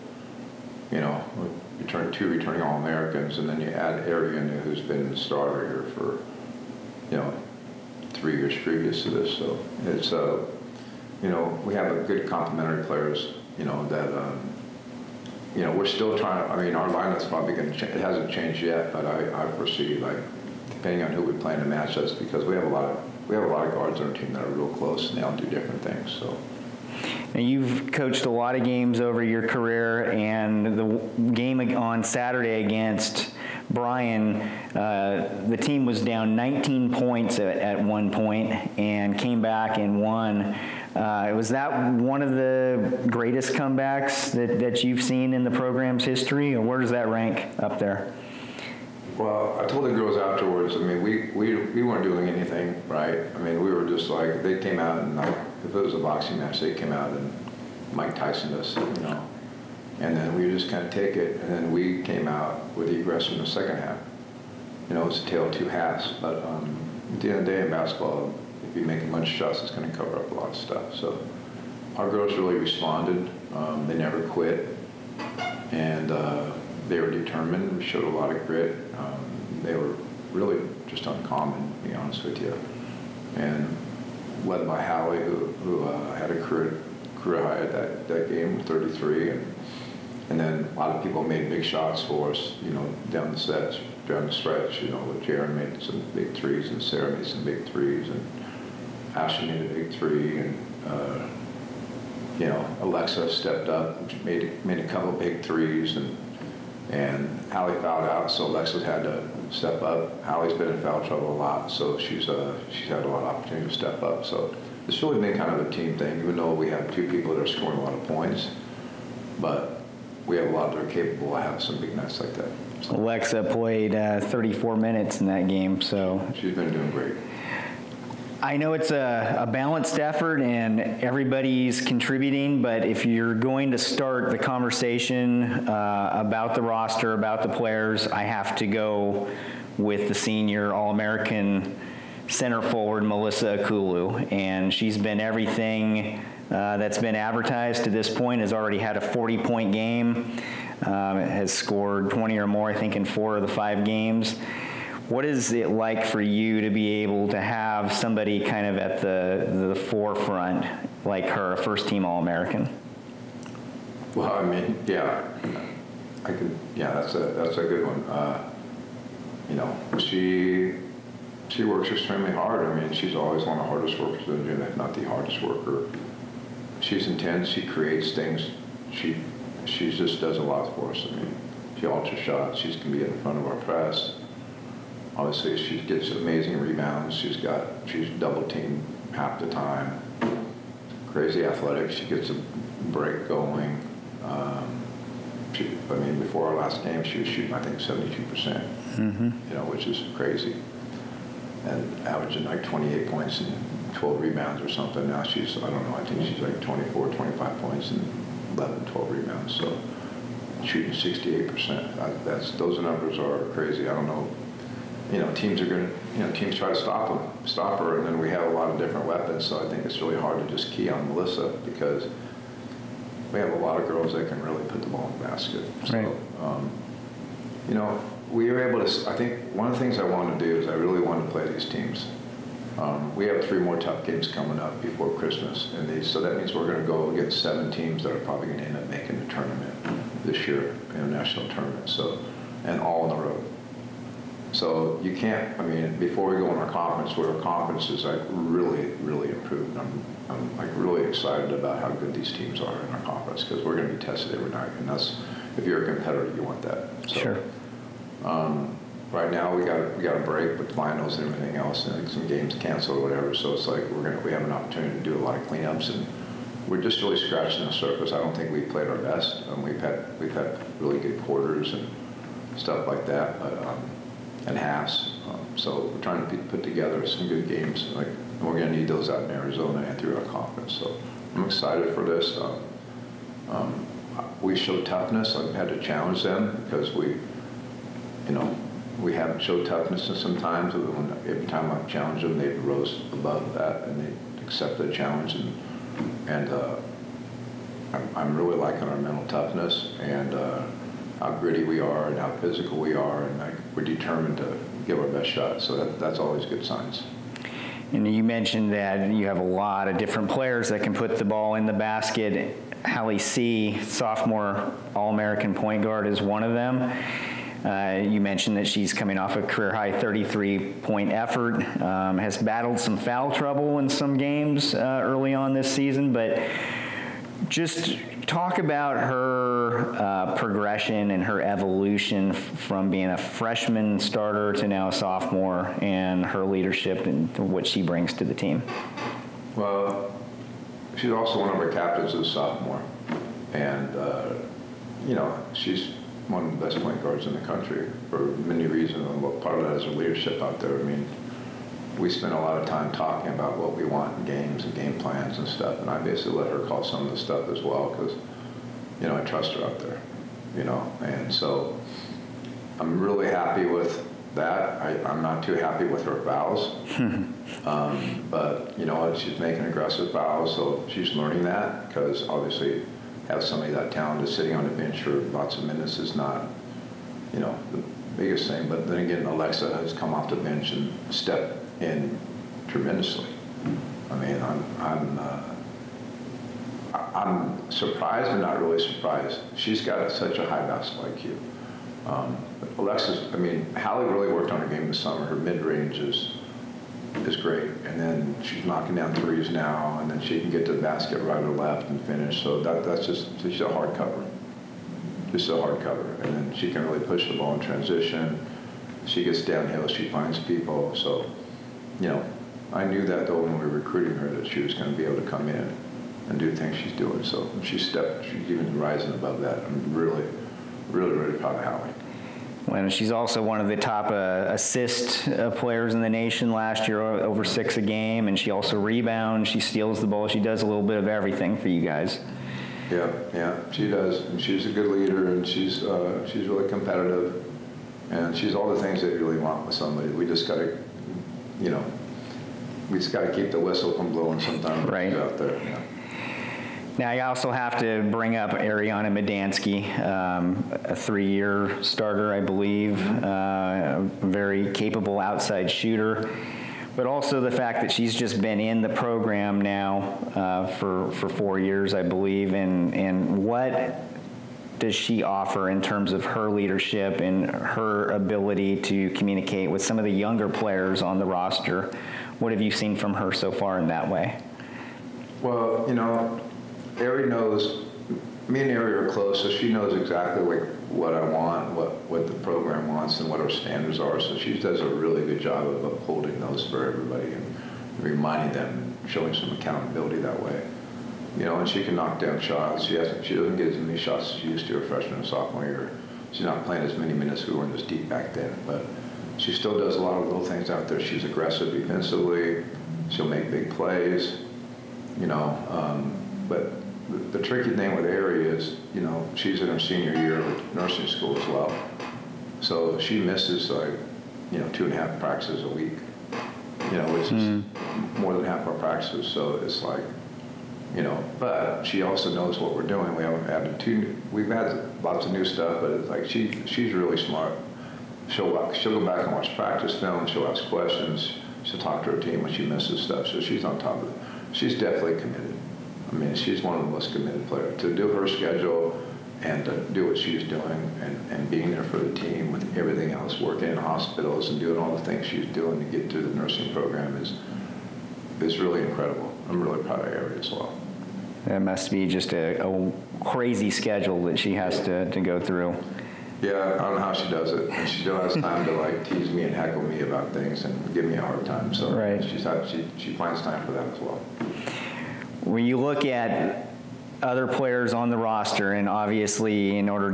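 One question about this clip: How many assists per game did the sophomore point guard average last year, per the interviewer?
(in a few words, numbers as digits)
over 6.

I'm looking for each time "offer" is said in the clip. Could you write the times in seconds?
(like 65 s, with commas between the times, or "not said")
465 s.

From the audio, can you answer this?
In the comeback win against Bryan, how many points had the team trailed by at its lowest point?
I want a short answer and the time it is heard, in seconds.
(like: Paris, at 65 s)
19, at 36 s.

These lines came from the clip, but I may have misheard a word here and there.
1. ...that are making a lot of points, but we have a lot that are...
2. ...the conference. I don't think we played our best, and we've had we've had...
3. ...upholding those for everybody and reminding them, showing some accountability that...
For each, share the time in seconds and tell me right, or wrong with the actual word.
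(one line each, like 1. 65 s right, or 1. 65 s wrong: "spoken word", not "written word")
1. 117 s wrong: "scoring", not "making"
2. 267 s wrong: "surface", not "conference"
3. 485 s right.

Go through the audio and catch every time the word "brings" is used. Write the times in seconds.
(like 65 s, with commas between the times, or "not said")
337 s, 448 s.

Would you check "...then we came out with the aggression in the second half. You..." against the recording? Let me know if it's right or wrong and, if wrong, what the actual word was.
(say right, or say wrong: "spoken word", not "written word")
right.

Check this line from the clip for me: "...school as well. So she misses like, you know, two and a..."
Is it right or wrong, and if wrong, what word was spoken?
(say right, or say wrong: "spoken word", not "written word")
right.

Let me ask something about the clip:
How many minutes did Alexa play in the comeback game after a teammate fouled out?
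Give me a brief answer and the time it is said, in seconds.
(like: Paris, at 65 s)
34, at 124 s.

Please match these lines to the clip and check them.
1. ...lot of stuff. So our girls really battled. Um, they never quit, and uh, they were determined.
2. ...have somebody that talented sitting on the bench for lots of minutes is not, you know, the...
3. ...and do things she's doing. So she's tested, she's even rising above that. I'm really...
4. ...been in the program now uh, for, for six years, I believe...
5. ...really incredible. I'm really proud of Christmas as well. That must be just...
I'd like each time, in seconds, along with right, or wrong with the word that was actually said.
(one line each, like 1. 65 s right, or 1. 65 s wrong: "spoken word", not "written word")
1. 70 s wrong: "responded", not "battled"
2. 373 s right
3. 416 s wrong: "stepped", not "tested"
4. 458 s wrong: "four", not "six"
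5. 548 s wrong: "Ari", not "Christmas".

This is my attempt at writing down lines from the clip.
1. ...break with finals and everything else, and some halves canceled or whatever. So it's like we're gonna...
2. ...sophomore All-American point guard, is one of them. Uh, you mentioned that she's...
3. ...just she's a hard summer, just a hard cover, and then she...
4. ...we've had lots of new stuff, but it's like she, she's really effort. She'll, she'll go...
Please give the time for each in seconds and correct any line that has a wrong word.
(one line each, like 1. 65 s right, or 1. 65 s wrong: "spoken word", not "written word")
1. 260 s wrong: "games", not "halves"
2. 313 s right
3. 403 s wrong: "cover", not "summer"
4. 524 s wrong: "smart", not "effort".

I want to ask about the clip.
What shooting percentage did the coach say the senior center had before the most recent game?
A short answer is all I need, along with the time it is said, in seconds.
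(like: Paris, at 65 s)
72 percent, at 197 s.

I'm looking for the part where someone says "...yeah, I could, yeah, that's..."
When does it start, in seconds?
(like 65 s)
164 s.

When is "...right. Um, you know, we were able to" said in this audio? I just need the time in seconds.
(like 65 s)
225 s.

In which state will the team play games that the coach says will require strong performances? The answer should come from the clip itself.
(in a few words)
Arizona.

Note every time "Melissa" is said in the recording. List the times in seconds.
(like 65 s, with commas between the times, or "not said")
143 s, 221 s.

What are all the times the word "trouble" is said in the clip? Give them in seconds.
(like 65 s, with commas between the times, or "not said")
111 s, 323 s.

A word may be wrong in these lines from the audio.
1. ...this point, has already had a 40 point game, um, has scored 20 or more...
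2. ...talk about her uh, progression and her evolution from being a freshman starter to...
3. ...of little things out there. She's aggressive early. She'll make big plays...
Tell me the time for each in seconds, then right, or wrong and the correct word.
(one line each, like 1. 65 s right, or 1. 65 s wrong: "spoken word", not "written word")
1. 147 s right
2. 328 s right
3. 500 s wrong: "defensively", not "early".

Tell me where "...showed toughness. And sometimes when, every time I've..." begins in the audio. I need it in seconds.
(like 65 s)
289 s.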